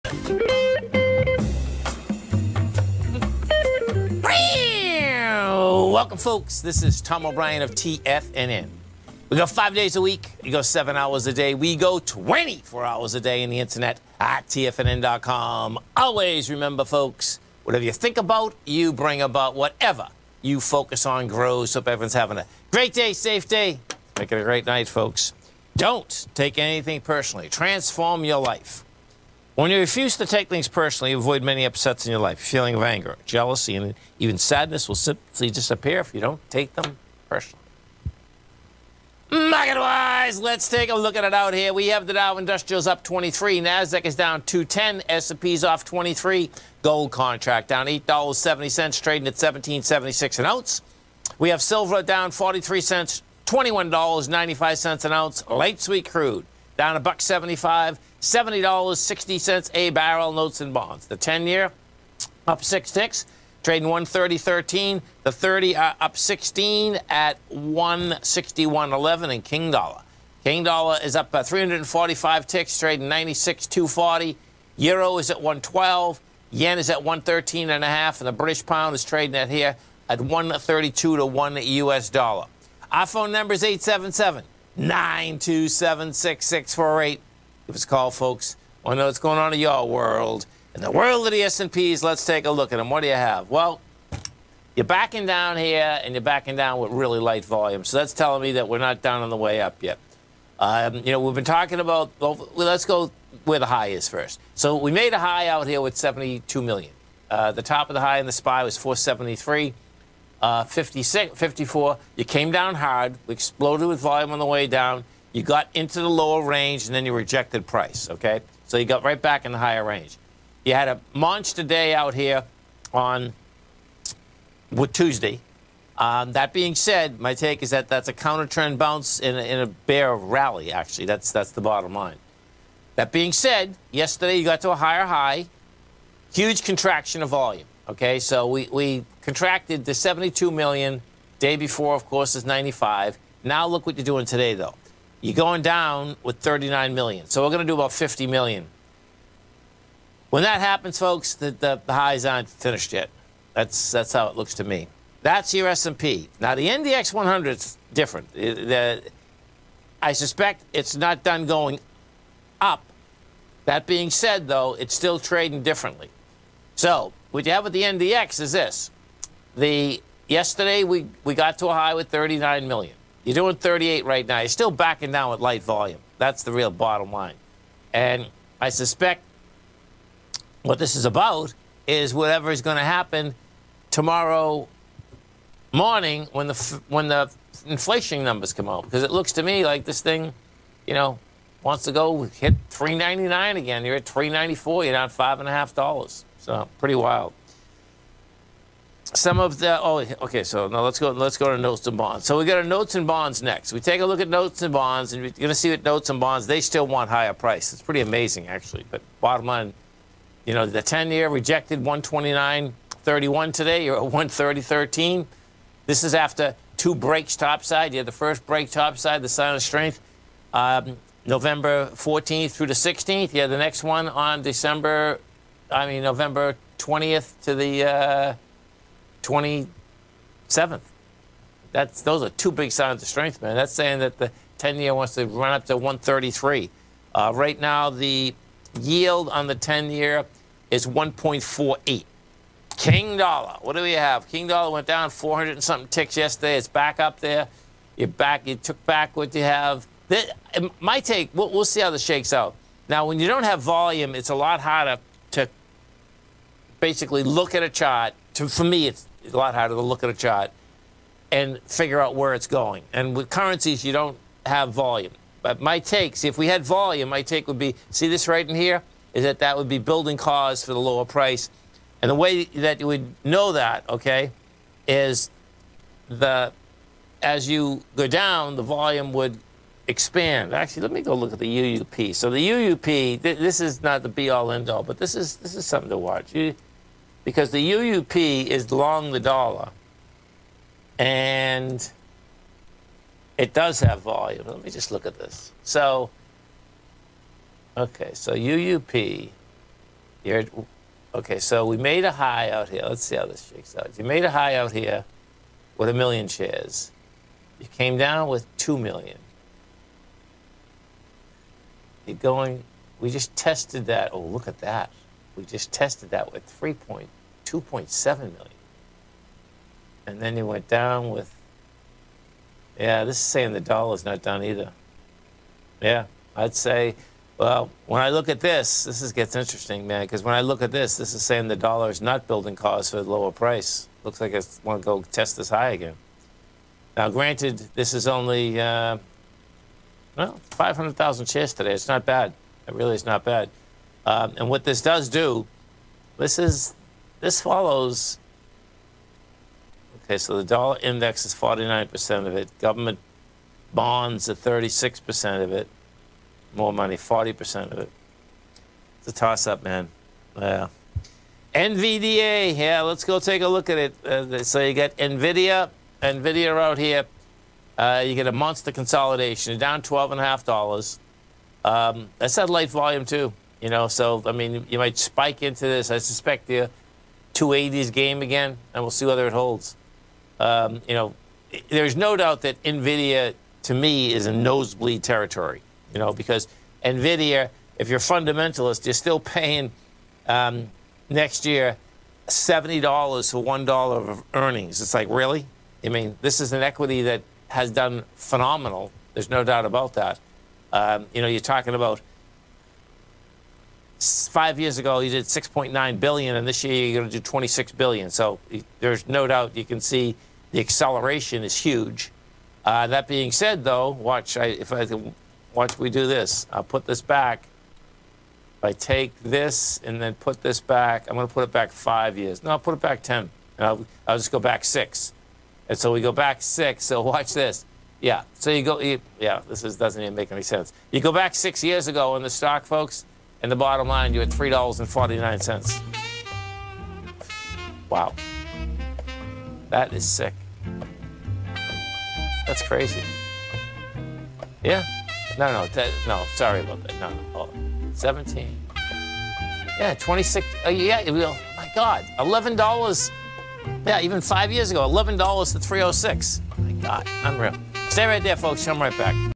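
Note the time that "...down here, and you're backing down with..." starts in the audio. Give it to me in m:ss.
1:35.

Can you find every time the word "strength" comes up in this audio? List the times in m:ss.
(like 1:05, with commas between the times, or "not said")
3:39, 3:53.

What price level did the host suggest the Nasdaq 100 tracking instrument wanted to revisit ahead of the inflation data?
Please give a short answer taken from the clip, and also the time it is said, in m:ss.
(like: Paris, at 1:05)
3.99, at 3:12.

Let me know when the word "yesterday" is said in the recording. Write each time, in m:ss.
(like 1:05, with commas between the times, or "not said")
2:13, 2:50, 4:06.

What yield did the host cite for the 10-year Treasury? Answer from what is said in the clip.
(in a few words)
1.48.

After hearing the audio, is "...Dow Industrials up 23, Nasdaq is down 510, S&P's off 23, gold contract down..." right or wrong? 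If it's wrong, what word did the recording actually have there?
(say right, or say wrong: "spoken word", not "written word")
wrong: "210", not "510".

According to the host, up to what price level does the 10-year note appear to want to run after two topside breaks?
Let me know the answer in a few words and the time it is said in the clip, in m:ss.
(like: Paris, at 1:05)
133, at 3:55.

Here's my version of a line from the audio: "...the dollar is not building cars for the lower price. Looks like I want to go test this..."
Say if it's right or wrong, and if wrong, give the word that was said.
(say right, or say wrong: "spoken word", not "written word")
right.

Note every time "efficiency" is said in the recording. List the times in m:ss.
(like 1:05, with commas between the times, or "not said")
not said.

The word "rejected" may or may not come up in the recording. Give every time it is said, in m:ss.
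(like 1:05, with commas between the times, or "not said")
1:57, 3:31.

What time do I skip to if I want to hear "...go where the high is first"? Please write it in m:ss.
1:42.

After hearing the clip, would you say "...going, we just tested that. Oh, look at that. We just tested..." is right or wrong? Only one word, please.
right.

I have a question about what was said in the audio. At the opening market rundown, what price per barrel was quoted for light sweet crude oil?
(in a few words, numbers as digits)
$70.60.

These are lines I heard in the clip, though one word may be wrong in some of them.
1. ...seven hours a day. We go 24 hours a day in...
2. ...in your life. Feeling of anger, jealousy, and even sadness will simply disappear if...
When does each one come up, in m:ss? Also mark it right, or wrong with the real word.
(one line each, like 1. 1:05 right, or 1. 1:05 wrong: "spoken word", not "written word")
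1. 0:10 right
2. 0:32 right.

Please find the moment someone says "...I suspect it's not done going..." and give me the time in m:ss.
2:40.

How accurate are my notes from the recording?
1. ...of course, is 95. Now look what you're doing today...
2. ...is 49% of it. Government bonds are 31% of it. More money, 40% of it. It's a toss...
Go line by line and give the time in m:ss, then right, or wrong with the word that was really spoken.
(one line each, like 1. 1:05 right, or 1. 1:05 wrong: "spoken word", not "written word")
1. 2:21 right
2. 5:51 wrong: "36", not "31".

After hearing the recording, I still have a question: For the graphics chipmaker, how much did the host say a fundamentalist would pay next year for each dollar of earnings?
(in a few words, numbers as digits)
$70.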